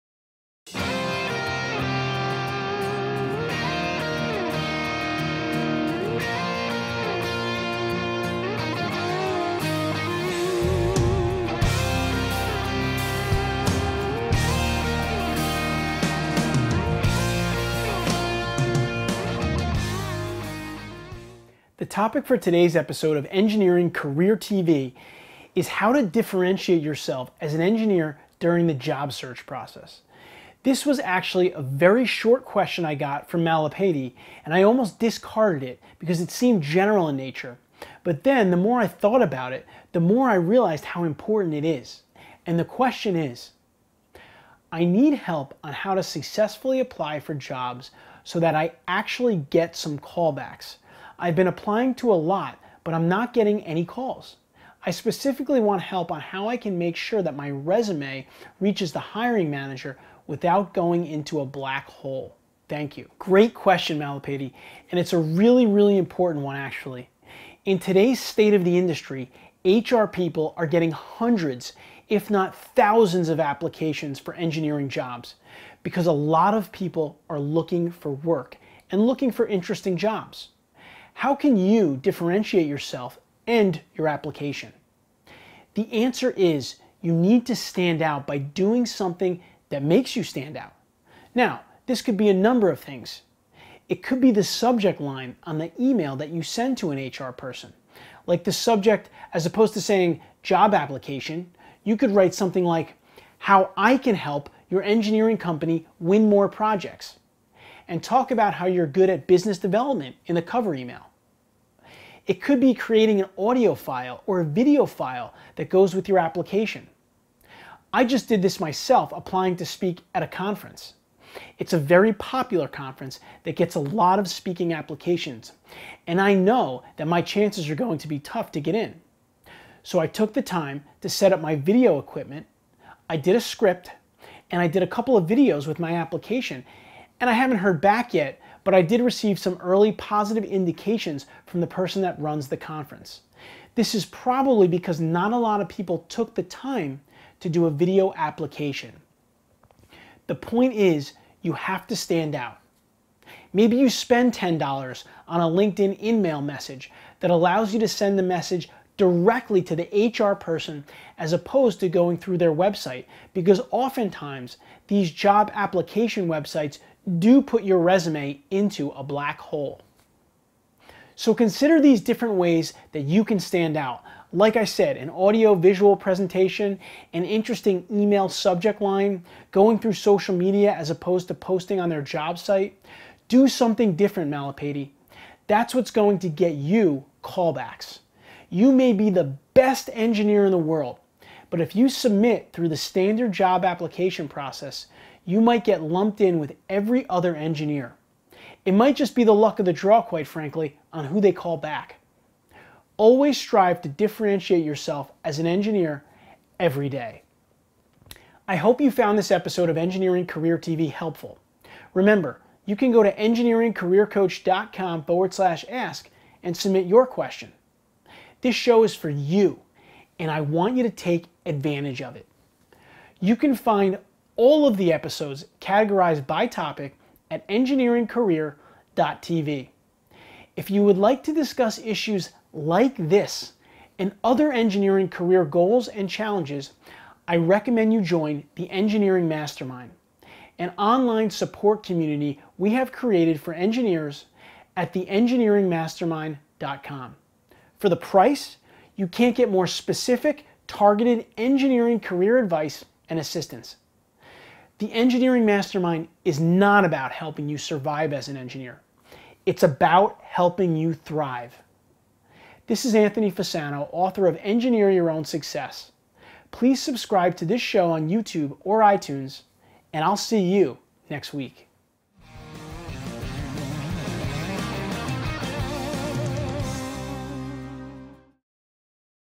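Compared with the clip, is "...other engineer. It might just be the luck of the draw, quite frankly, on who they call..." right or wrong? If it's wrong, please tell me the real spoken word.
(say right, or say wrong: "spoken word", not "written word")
right.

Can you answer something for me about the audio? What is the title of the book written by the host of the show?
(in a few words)
Engineer Your Own Success.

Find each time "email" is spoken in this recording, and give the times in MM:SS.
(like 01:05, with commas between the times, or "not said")
01:35, 01:50, 02:36, 02:57.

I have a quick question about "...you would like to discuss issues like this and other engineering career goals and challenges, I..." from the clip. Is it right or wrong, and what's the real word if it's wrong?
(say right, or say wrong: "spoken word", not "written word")
right.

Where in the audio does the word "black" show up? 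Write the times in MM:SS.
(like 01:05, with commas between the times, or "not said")
01:01, 02:49.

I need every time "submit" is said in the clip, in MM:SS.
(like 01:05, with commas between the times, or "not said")
03:11, 03:36.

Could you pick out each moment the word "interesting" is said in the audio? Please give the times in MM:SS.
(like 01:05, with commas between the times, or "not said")
01:19, 02:57.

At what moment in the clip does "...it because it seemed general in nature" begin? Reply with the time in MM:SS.
00:35.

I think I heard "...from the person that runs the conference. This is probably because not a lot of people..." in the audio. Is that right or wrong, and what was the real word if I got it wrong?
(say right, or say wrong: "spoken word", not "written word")
right.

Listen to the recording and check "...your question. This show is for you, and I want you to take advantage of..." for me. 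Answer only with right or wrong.
right.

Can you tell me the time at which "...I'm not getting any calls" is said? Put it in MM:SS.
00:52.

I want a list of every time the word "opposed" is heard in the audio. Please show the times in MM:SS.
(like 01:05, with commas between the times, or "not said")
01:39, 02:41, 03:00.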